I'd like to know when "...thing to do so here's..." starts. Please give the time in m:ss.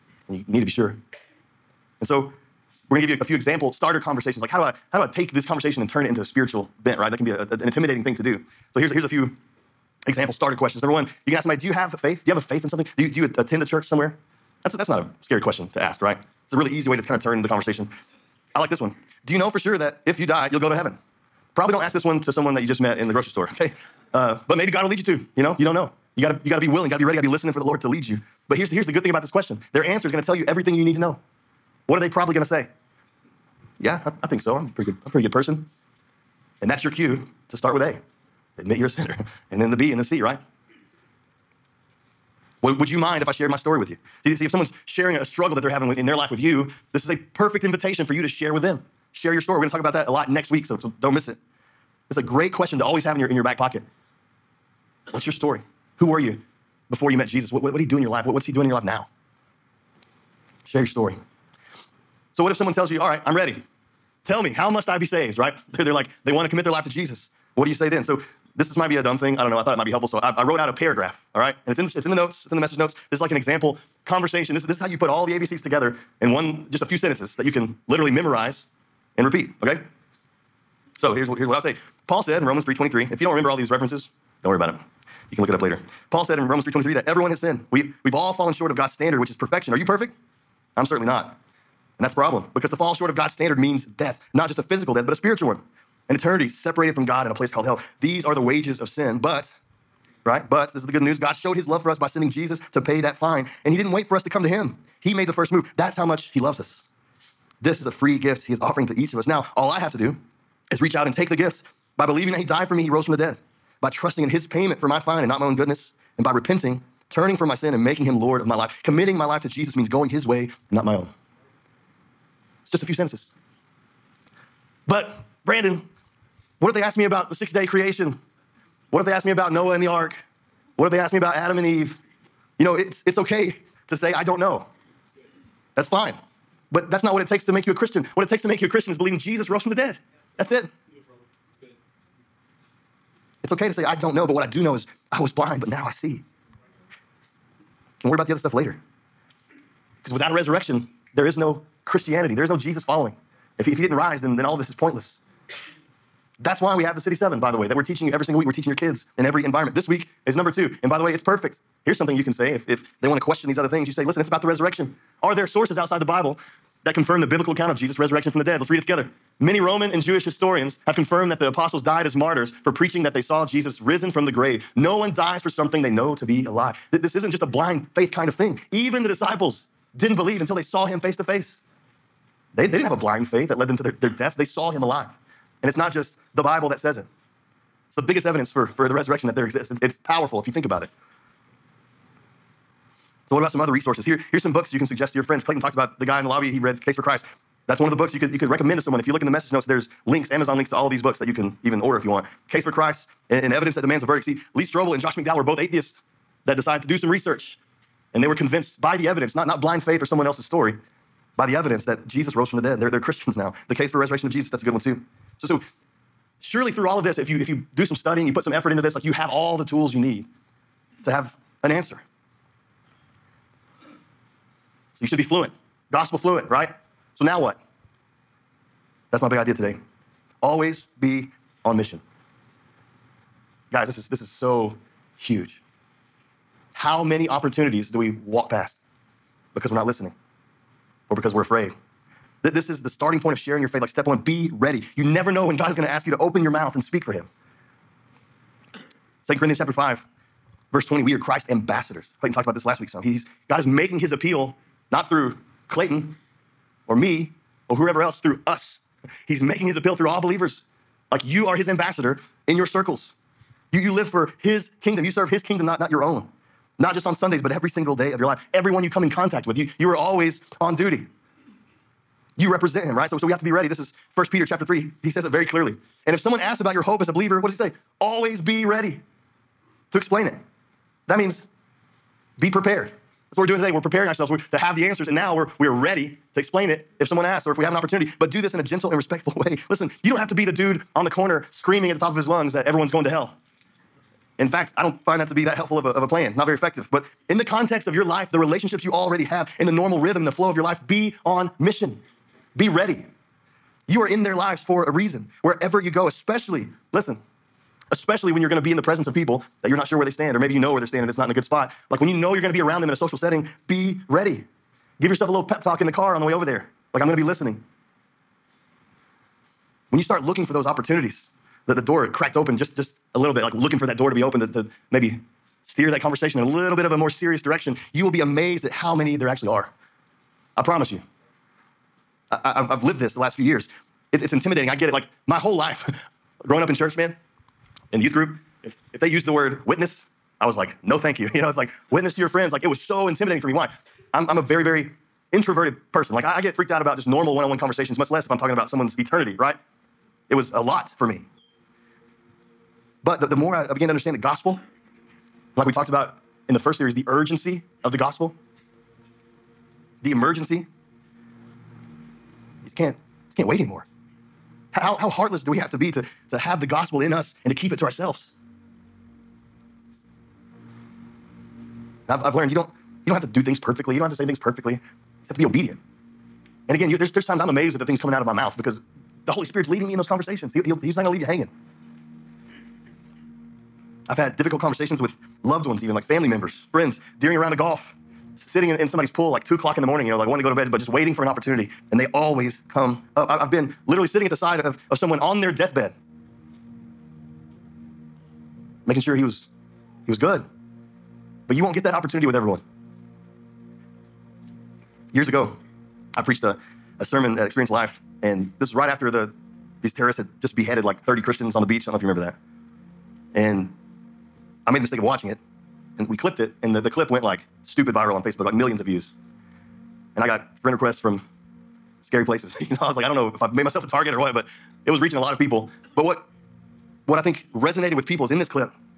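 0:08.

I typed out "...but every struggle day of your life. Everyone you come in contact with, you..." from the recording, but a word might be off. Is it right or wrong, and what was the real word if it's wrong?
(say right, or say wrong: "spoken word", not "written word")
wrong: "single", not "struggle".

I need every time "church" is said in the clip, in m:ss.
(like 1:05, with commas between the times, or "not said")
0:13, 5:36.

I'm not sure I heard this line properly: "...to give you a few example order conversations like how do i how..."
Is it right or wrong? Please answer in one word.
wrong.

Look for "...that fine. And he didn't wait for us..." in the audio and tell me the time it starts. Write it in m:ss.
1:43.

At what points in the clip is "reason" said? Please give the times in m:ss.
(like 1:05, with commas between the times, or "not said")
5:04.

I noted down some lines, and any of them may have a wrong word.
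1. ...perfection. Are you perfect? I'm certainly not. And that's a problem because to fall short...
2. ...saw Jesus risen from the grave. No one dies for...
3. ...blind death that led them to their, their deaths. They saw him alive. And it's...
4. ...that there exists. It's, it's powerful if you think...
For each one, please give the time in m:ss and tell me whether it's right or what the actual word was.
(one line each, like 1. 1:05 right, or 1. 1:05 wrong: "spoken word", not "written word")
1. 1:29 right
2. 2:53 right
3. 3:02 wrong: "faith", not "death"
4. 3:09 right.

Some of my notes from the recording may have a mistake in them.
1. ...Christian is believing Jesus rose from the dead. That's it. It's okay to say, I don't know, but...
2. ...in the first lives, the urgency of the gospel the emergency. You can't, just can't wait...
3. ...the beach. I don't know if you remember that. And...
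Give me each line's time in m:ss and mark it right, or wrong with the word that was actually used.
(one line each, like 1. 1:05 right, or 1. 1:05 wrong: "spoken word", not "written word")
1. 2:18 right
2. 5:56 wrong: "series", not "lives"
3. 6:51 right.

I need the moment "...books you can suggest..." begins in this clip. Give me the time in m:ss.
3:14.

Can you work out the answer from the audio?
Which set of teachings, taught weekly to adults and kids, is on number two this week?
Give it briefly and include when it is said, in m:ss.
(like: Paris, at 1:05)
City Seven, at 2:36.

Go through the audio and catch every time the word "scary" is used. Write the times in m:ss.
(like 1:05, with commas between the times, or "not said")
0:15, 7:02.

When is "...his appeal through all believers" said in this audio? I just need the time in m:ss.
4:19.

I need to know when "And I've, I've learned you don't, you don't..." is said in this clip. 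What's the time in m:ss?
6:12.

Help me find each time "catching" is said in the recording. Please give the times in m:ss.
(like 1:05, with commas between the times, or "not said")
not said.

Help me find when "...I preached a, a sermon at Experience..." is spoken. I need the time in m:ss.
6:46.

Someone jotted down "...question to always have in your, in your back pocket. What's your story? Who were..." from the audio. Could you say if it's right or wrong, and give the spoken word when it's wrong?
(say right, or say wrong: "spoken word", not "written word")
right.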